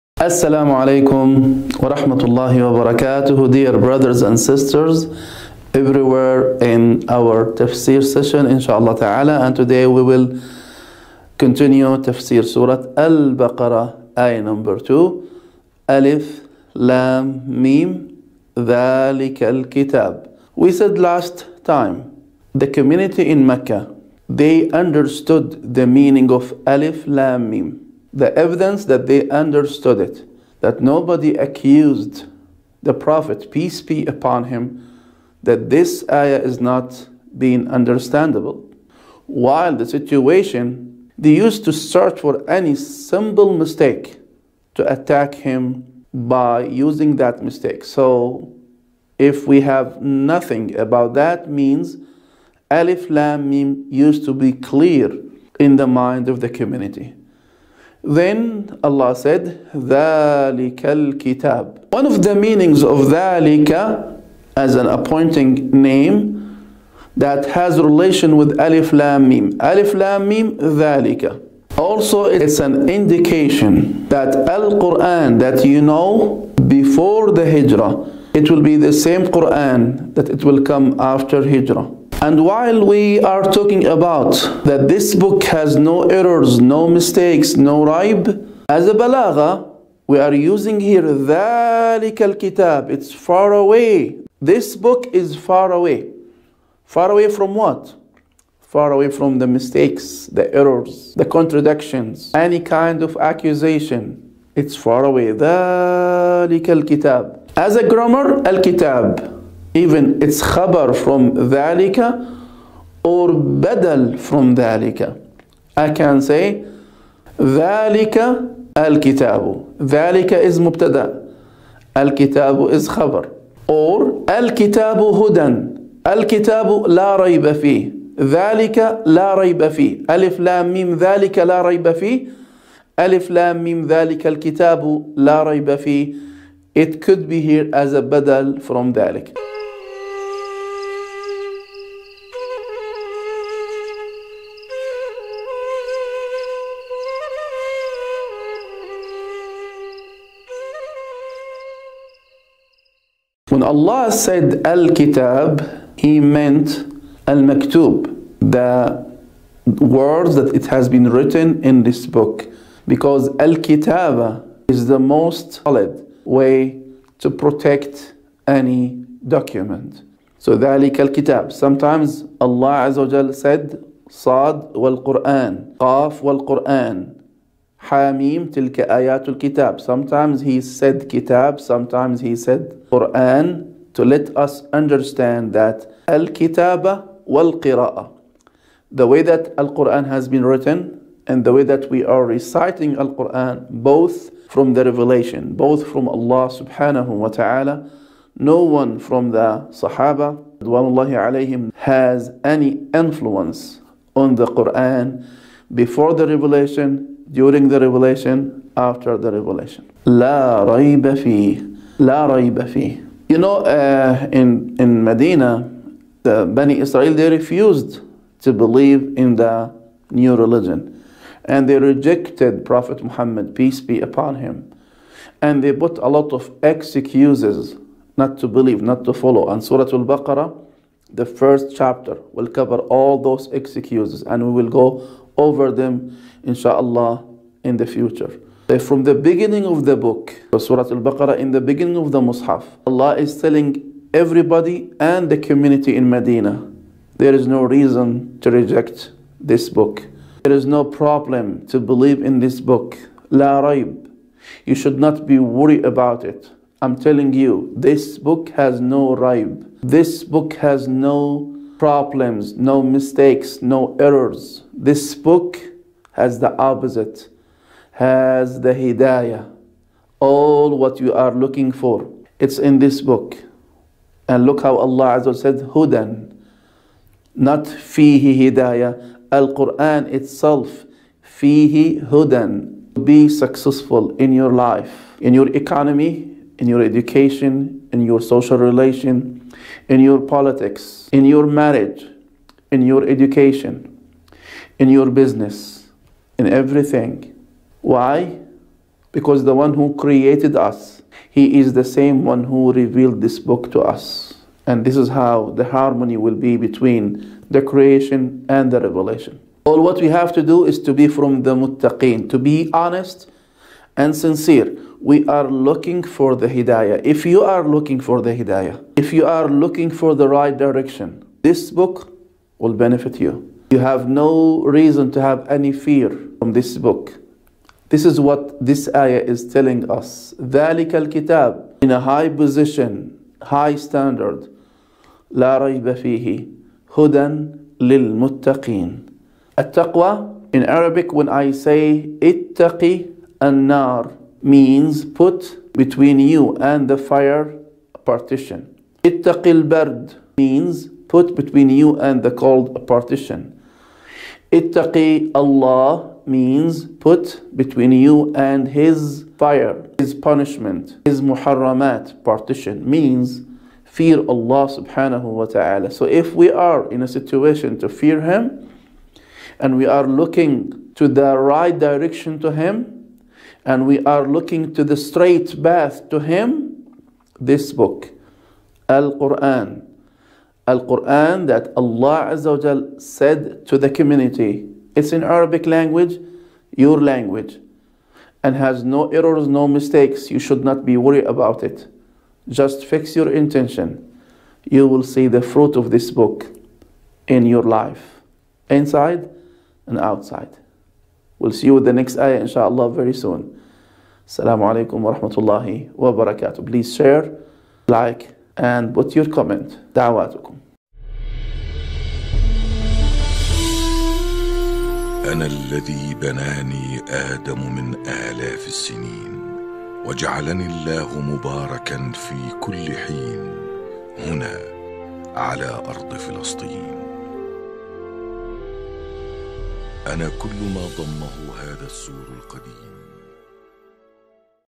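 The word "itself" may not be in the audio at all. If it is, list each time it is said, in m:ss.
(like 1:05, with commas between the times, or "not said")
4:40.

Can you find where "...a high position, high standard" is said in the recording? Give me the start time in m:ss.
5:31.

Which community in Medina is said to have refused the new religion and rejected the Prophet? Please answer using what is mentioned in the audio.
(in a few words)
Bani Israel.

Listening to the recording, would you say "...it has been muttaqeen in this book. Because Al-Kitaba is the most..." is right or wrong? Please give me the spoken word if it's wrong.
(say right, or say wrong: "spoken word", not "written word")
wrong: "written", not "muttaqeen".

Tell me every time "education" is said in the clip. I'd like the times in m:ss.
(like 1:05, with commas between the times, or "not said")
4:46, 4:53.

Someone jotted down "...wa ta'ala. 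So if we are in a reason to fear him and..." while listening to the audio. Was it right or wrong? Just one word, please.
wrong.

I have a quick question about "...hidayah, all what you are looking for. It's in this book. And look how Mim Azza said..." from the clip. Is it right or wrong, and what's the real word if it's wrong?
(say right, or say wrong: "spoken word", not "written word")
wrong: "Allah", not "Mim".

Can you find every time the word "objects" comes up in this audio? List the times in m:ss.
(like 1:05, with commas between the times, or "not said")
not said.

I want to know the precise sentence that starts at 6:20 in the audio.
Al Quran that Allah Azza said to the community.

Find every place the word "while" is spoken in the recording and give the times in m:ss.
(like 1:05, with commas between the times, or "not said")
0:39, 1:22.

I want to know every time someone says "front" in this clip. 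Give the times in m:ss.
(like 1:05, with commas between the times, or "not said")
not said.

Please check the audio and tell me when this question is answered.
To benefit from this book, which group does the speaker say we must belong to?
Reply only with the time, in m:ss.
5:11.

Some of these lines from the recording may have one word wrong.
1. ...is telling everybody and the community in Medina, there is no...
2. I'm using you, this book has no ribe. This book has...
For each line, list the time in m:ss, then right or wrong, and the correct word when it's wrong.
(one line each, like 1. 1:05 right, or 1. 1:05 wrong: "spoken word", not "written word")
1. 4:03 right
2. 4:16 wrong: "telling", not "using".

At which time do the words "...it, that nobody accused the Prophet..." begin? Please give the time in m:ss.
0:29.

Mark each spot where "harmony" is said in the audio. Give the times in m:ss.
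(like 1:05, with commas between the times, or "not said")
5:05.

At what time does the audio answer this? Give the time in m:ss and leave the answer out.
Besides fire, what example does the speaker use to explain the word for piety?
5:49.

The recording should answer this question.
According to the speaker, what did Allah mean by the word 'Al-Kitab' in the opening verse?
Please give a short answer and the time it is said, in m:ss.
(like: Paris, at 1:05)
Al-Maktub, at 2:37.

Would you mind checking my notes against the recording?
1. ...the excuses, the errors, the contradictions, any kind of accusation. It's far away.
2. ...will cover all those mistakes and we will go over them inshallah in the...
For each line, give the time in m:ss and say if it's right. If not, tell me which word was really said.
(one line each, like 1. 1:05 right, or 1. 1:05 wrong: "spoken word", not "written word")
1. 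1:39 wrong: "mistakes", not "excuses"
2. 3:52 wrong: "excuses", not "mistakes".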